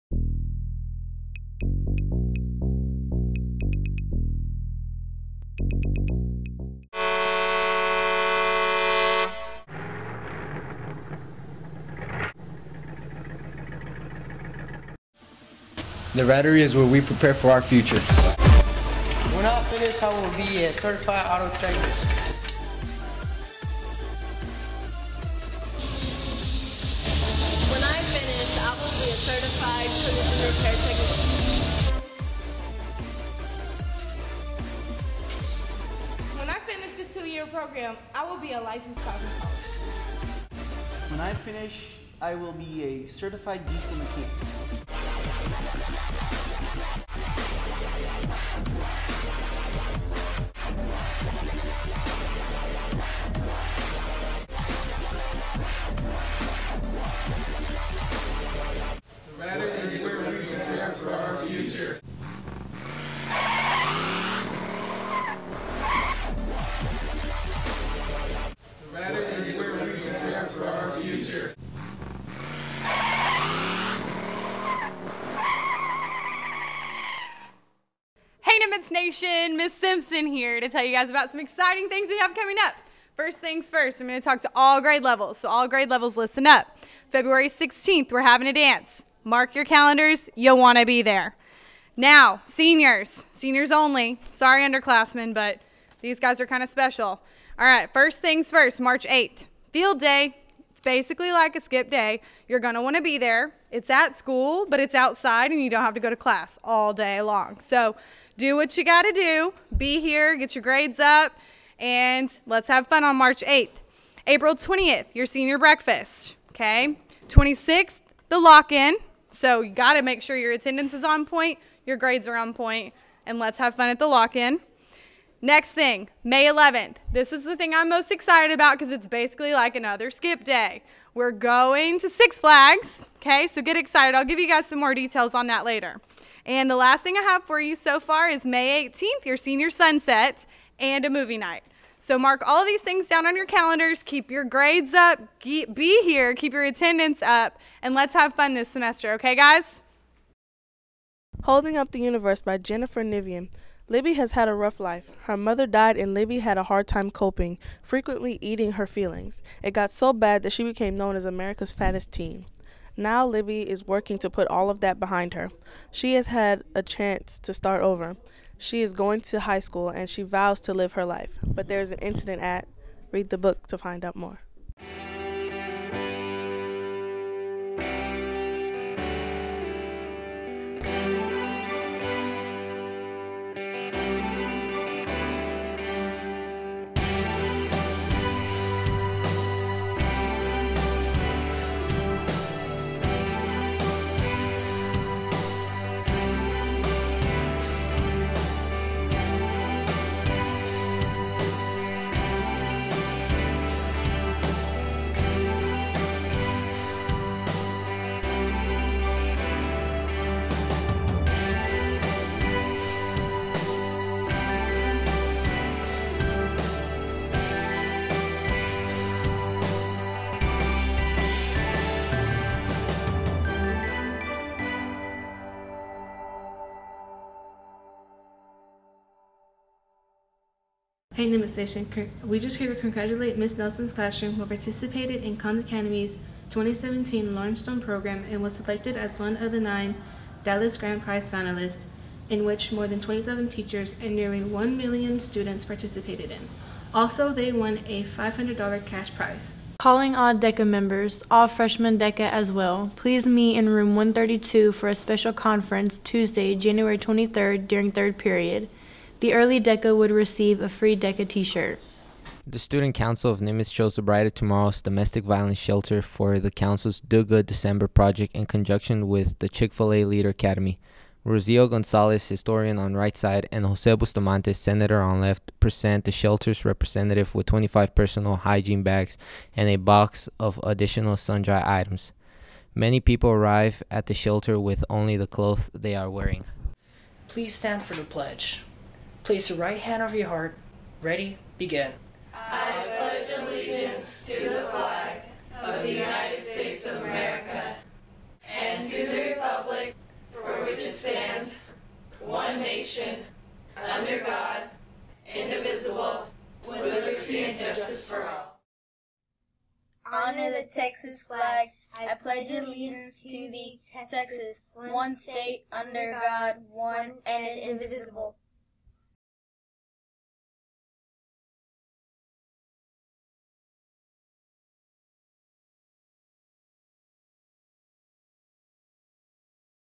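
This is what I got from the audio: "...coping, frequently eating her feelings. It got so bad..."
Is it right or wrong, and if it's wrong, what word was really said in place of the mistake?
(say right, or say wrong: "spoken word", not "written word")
right.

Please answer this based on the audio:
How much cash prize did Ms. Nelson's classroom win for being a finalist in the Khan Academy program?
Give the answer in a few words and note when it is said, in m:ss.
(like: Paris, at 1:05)
$500, at 4:08.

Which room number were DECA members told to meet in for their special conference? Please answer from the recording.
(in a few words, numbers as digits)
132.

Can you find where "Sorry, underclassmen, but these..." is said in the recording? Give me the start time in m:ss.
1:34.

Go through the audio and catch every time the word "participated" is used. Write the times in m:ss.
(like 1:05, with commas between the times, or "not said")
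3:54, 4:05.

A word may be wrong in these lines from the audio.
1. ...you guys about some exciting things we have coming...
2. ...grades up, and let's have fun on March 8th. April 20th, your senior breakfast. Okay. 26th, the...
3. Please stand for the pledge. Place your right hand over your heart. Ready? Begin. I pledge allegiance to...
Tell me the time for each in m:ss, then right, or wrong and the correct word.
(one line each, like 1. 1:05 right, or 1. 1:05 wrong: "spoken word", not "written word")
1. 1:20 right
2. 1:50 right
3. 4:47 right.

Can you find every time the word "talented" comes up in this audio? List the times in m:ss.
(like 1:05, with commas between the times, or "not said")
not said.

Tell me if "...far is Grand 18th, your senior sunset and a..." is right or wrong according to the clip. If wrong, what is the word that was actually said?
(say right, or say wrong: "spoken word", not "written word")
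wrong: "May", not "Grand".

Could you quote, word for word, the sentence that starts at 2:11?
We're going to Six Flags, okay?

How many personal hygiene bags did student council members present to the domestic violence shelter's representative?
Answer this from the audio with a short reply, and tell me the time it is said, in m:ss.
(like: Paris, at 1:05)
25, at 4:37.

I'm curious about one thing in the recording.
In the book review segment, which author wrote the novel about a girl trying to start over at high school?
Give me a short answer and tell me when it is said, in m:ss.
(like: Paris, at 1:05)
Jennifer Niven, at 2:32.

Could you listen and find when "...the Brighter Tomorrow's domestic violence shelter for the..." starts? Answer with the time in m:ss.
4:23.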